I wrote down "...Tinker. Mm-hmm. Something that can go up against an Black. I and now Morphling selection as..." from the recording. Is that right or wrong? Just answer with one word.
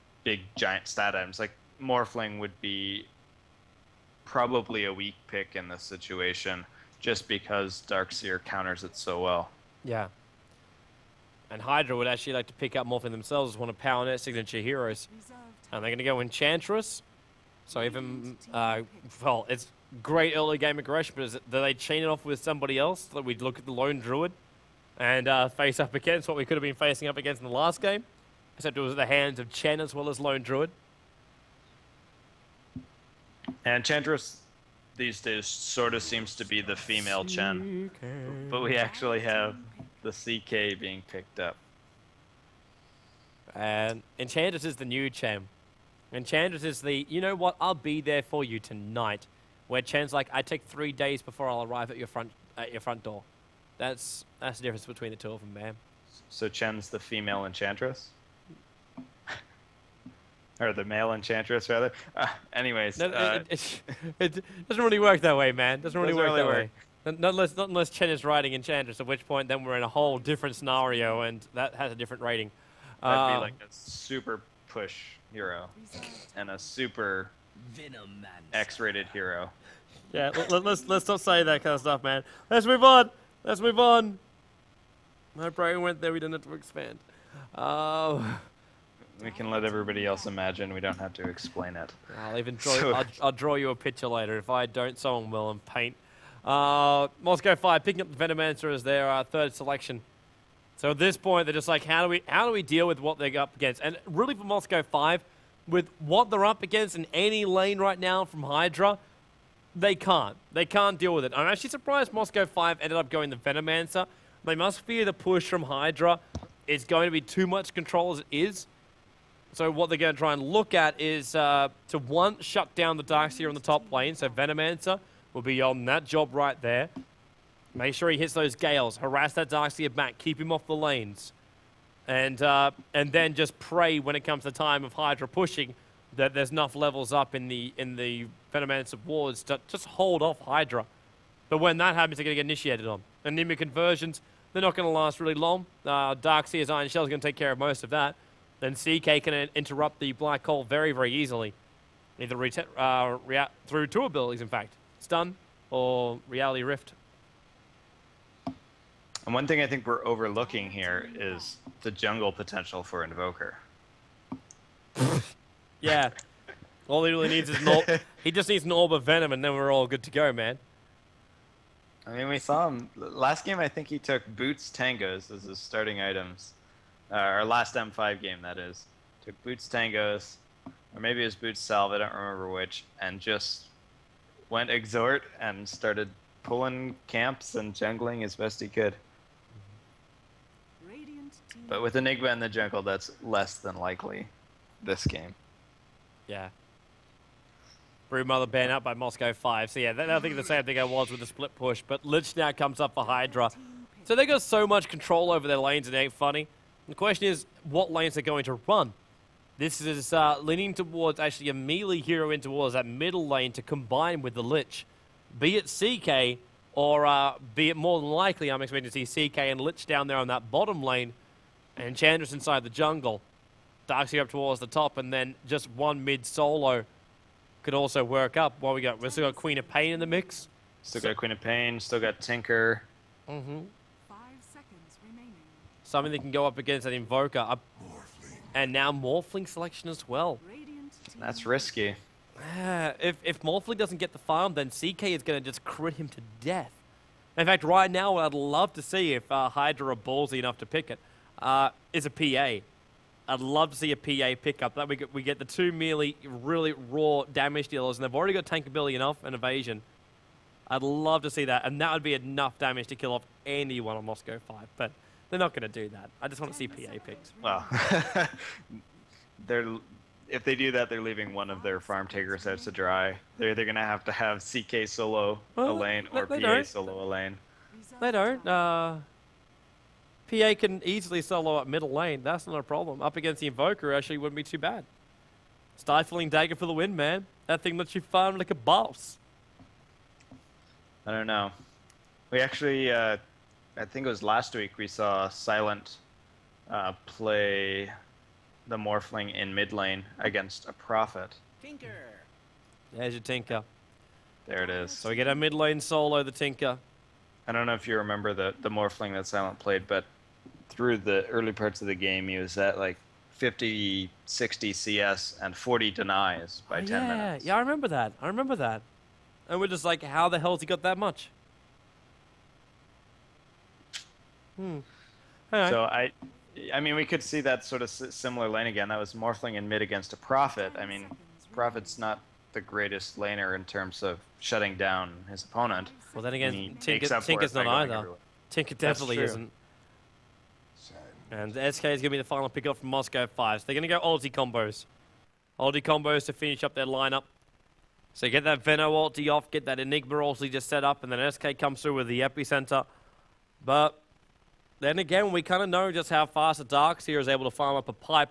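wrong.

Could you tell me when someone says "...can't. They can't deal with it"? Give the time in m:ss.
1:49.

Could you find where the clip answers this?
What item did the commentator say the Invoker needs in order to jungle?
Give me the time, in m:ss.
2:48.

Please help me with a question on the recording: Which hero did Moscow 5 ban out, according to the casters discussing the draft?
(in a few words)
Broodmother.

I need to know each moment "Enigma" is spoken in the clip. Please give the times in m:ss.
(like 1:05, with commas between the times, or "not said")
3:11, 5:49.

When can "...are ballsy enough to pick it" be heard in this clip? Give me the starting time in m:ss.
4:09.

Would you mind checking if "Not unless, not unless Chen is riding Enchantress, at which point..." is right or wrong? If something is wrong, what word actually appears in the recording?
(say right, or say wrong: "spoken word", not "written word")
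right.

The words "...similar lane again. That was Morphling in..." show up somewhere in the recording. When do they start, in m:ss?
5:27.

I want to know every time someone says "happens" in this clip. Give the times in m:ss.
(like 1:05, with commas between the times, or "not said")
2:21.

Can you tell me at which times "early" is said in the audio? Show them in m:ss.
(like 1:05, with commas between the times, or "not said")
0:20, 5:11.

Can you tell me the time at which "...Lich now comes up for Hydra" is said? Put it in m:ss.
3:22.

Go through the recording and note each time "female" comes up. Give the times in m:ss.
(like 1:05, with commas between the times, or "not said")
0:36, 0:56.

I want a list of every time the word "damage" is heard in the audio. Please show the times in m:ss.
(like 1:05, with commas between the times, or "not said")
4:17, 4:22.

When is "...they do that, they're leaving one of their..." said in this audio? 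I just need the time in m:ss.
4:30.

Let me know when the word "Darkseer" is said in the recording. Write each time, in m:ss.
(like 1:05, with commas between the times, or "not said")
0:07, 2:03, 2:09, 2:26, 3:43, 5:56.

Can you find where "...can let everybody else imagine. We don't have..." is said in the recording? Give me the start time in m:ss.
1:29.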